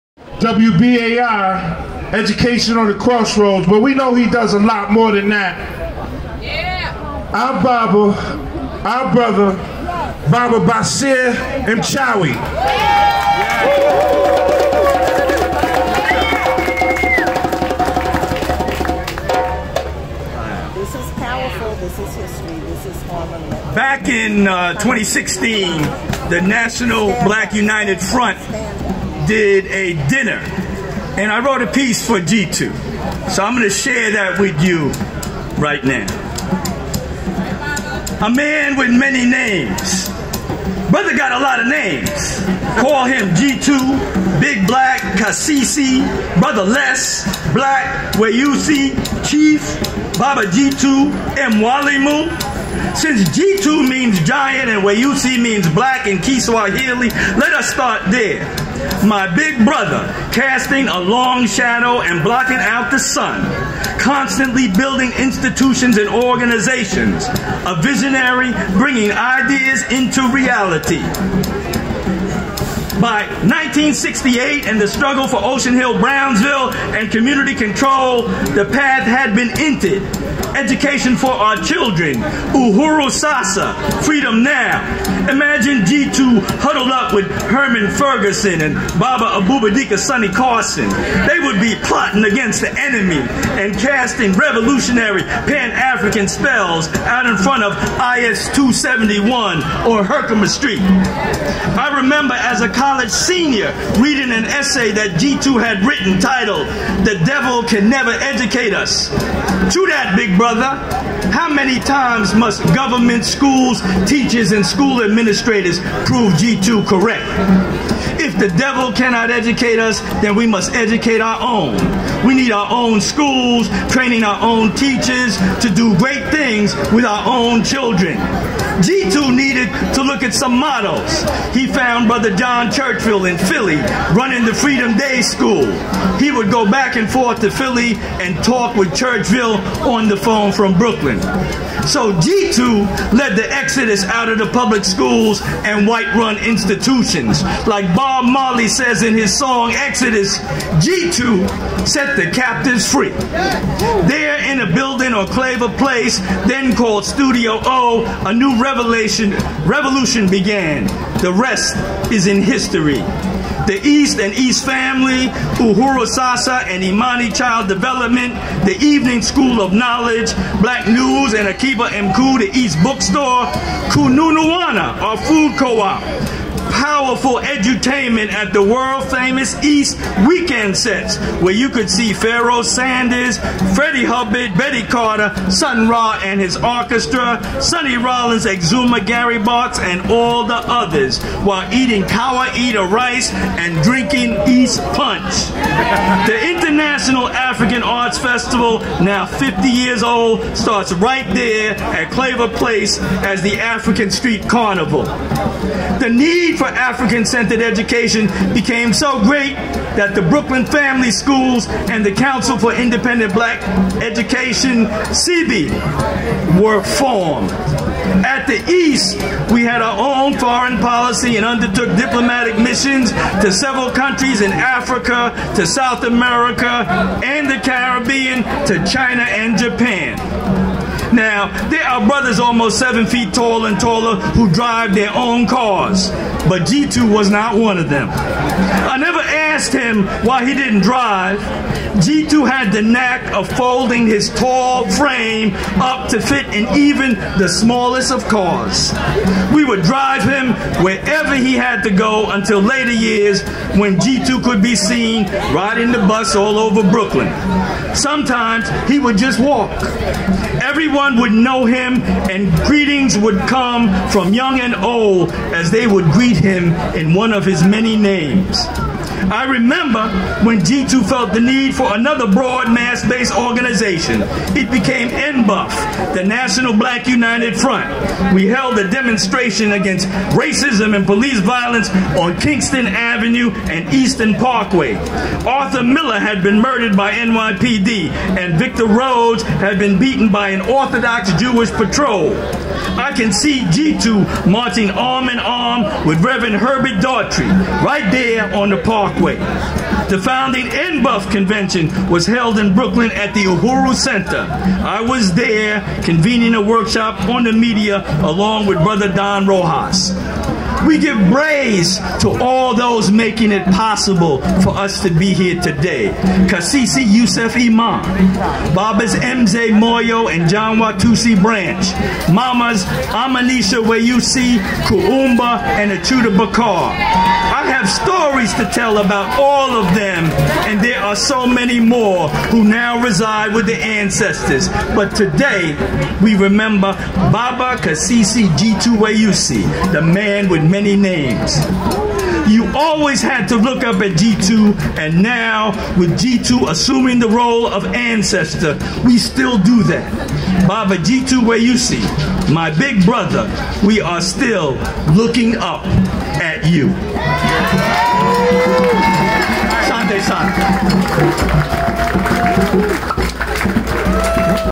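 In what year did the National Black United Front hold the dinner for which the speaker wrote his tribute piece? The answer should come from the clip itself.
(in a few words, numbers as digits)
2016.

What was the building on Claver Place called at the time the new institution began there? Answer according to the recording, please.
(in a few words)
Studio O.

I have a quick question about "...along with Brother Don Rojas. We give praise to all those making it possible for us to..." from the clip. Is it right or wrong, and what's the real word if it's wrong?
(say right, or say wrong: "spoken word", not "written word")
right.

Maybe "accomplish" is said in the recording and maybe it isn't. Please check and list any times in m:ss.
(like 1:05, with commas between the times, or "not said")
not said.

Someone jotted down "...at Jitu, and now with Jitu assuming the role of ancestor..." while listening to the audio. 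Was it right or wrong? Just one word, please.
right.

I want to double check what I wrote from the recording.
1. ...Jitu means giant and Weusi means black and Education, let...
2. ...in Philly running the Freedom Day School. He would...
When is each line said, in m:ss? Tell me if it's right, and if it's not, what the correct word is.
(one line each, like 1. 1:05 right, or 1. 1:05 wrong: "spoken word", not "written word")
1. 0:53 wrong: "Kiswahili", not "Education"
2. 2:13 right.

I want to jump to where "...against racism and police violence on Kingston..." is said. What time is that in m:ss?
4:39.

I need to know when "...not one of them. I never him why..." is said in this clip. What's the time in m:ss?
3:57.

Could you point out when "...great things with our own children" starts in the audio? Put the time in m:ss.
2:05.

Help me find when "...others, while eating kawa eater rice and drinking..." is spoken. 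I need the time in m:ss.
3:10.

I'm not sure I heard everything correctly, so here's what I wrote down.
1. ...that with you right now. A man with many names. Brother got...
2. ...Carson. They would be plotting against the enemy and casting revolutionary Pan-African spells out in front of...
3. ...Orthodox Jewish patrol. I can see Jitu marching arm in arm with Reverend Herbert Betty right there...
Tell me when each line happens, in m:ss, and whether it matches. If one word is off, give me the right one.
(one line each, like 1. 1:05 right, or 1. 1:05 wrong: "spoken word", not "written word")
1. 0:34 right
2. 1:30 right
3. 4:50 wrong: "Daughtry", not "Betty".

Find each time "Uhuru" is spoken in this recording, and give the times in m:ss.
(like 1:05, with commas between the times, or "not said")
1:22, 2:45, 5:03.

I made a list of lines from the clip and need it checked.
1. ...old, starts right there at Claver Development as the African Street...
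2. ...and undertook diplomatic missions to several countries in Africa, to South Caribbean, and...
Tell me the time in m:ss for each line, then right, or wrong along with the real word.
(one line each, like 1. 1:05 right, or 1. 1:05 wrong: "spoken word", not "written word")
1. 3:20 wrong: "Place", not "Development"
2. 3:41 wrong: "America", not "Caribbean".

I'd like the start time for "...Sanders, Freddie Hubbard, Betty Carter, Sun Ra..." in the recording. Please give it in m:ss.
3:02.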